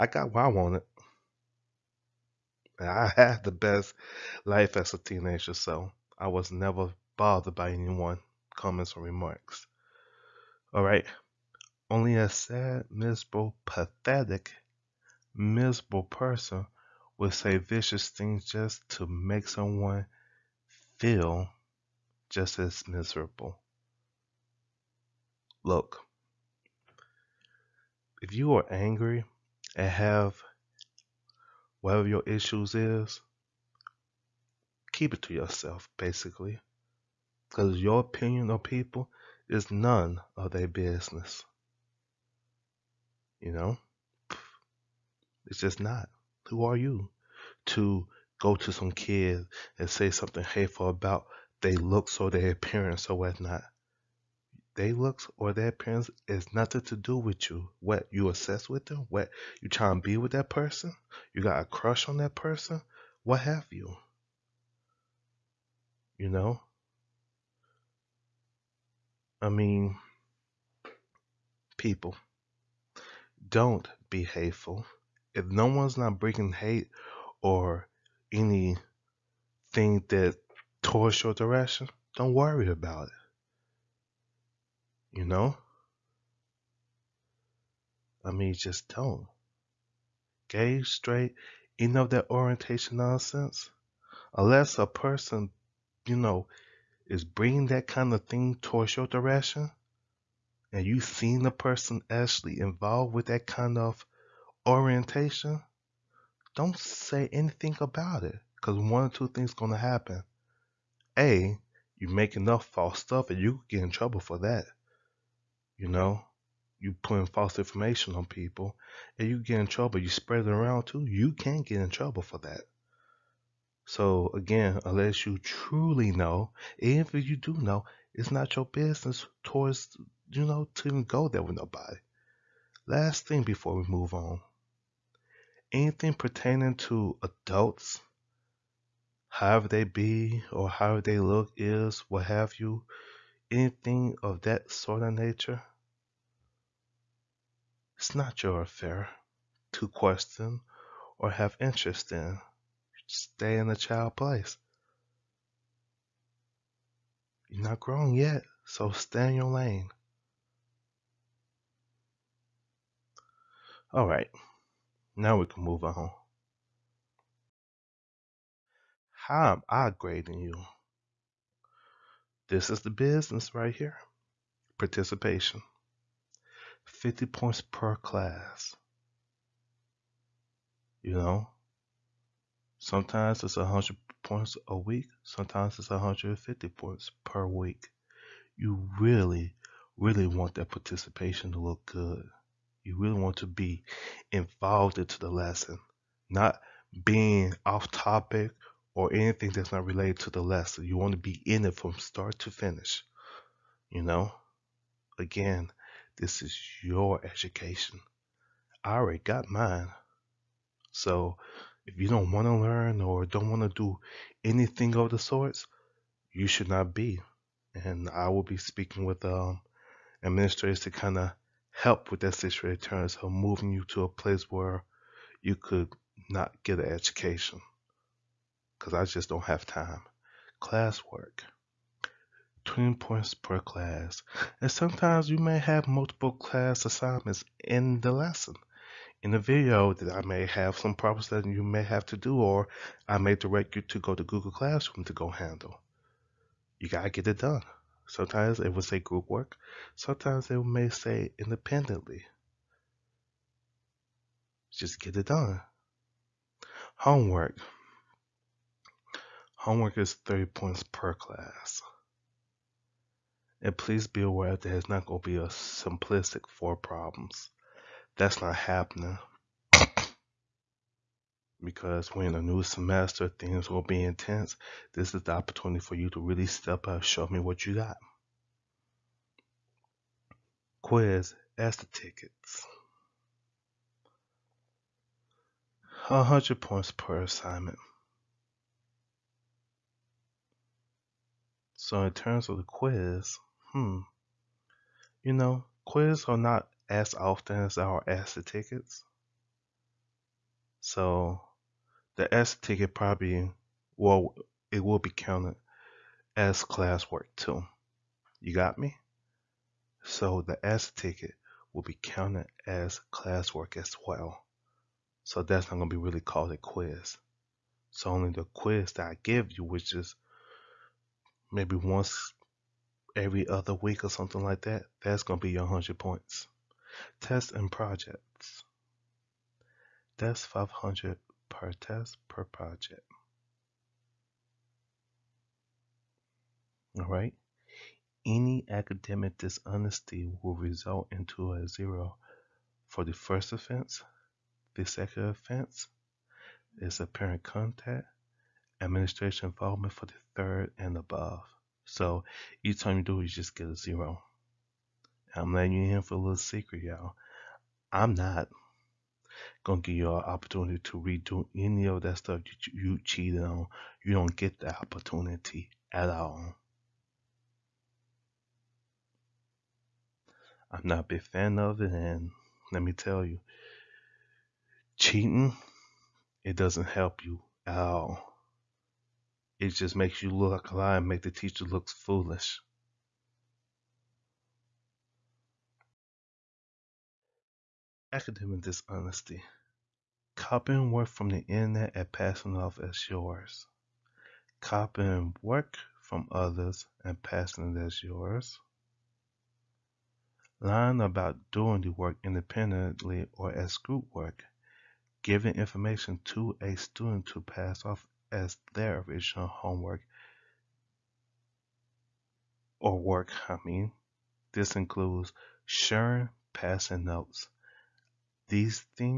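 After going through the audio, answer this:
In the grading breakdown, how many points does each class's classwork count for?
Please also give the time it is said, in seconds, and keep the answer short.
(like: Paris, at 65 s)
20, at 232 s.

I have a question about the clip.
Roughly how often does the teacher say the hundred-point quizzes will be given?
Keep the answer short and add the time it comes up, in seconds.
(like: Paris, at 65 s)
once every other week, at 321 s.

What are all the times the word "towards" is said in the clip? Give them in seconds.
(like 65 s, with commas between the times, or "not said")
80 s, 98 s, 129 s.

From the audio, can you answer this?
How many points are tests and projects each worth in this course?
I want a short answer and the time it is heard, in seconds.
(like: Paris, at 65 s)
500, at 330 s.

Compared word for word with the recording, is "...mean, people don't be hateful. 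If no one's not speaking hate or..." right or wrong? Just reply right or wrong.
wrong.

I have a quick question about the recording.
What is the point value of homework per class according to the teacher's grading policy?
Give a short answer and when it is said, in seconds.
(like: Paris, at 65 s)
30, at 260 s.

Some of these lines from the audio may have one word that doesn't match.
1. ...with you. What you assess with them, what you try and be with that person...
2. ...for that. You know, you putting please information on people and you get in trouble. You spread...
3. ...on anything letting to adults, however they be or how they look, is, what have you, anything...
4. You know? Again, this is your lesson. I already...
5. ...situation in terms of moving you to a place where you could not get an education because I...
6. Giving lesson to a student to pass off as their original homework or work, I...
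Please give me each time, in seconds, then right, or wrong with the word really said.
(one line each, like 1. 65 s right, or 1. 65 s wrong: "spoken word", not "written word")
1. 57 s right
2. 114 s wrong: "false", not "please"
3. 134 s wrong: "pertaining", not "letting"
4. 203 s wrong: "education", not "lesson"
5. 222 s right
6. 405 s wrong: "information", not "lesson".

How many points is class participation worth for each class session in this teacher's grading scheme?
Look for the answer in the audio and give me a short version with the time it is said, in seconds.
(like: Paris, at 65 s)
50, at 176 s.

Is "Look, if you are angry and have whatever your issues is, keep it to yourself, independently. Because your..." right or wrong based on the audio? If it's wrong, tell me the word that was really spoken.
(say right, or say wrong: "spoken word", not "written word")
wrong: "basically", not "independently".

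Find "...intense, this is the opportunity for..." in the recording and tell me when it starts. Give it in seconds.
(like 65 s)
274 s.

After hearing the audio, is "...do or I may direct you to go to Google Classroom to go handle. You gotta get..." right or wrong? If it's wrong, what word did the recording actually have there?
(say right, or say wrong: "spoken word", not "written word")
right.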